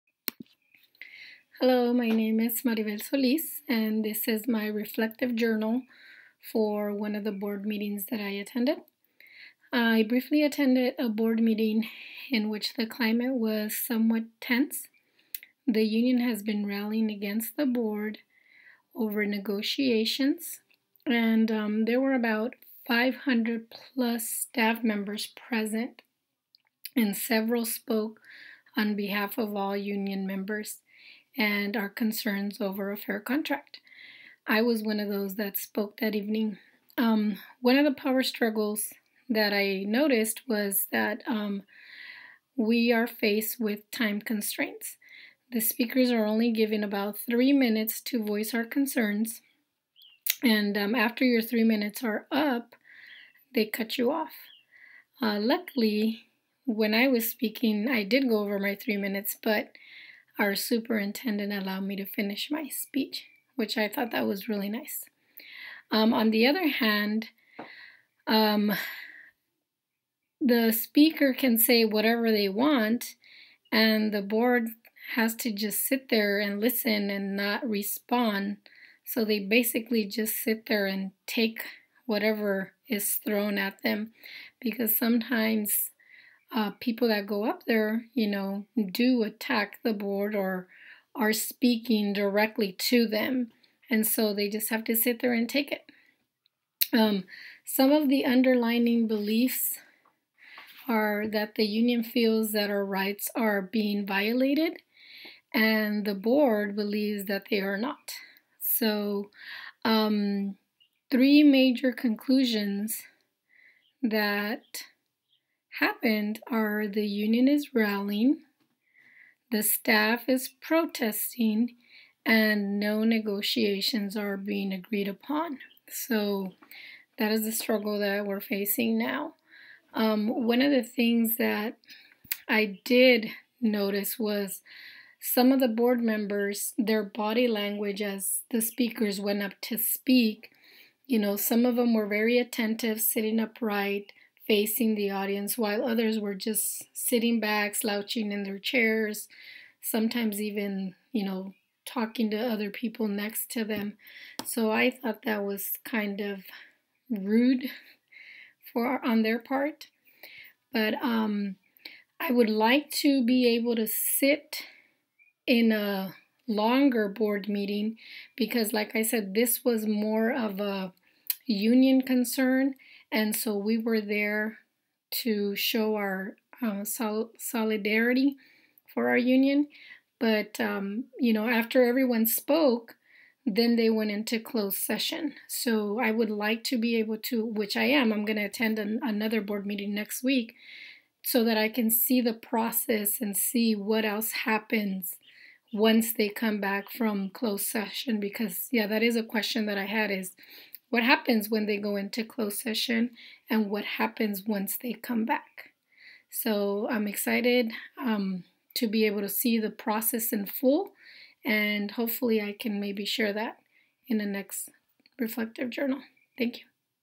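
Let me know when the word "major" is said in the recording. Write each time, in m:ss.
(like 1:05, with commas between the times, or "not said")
1:51.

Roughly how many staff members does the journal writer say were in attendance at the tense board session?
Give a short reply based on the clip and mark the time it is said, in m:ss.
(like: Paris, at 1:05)
500 plus, at 0:22.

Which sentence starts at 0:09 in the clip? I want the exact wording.
I briefly attended a board meeting in which the climate was somewhat tense.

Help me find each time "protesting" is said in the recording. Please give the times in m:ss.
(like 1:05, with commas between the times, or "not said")
2:00.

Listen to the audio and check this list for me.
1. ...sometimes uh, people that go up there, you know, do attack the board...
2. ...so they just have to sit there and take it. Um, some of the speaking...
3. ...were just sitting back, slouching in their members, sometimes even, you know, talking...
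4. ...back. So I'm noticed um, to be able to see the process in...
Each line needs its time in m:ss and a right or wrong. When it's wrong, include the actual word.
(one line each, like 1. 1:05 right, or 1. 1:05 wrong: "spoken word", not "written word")
1. 1:24 right
2. 1:34 wrong: "underlining", not "speaking"
3. 2:26 wrong: "chairs", not "members"
4. 3:25 wrong: "excited", not "noticed".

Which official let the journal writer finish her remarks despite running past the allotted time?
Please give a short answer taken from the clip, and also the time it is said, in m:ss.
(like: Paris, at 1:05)
superintendent, at 1:00.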